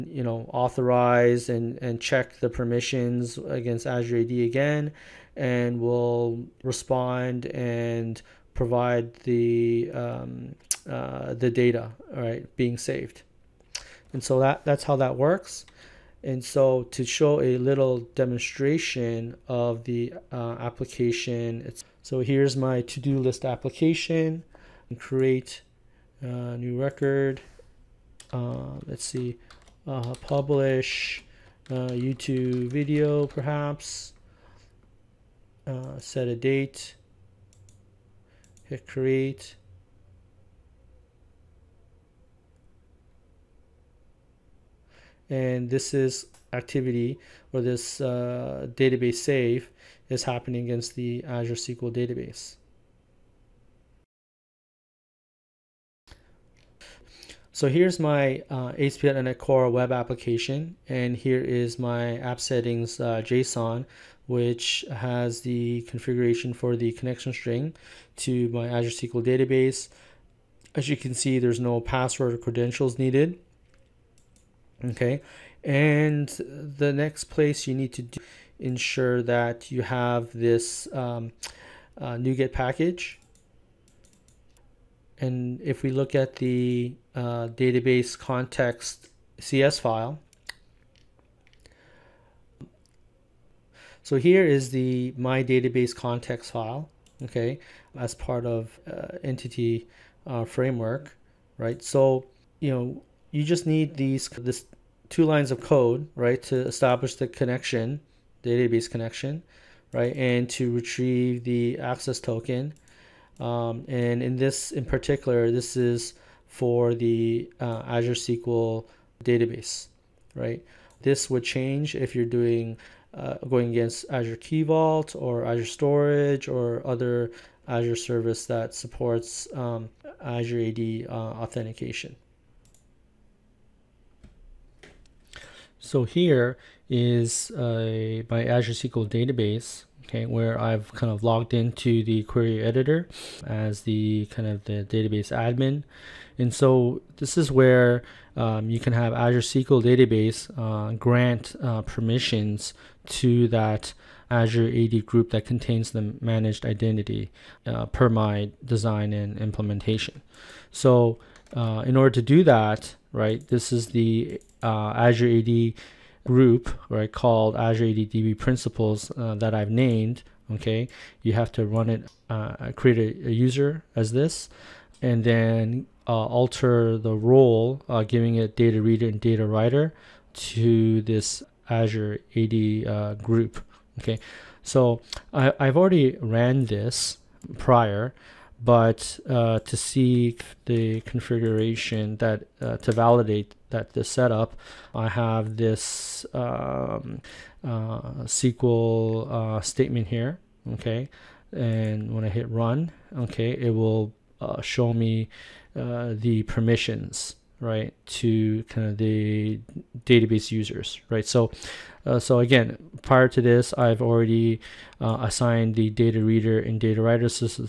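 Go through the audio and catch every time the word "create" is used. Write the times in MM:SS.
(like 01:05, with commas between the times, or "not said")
00:24, 00:38, 02:52.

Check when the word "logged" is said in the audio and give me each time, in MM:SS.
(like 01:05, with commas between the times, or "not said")
02:21.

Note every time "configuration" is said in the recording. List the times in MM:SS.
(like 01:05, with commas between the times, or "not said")
01:05, 03:11.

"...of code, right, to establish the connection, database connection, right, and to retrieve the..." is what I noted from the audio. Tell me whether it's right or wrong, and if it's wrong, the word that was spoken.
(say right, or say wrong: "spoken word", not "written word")
right.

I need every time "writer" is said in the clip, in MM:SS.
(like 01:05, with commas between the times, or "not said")
02:59, 03:37.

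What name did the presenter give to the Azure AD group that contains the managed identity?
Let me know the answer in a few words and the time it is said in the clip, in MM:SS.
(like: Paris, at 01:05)
Azure AD DB principles, at 02:47.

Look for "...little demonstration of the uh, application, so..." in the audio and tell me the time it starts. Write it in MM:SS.
00:17.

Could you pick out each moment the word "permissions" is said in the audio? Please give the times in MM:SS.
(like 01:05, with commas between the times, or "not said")
00:02, 02:31, 03:26.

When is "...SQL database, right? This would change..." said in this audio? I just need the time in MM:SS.
01:58.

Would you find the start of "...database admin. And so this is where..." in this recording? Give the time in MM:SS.
02:24.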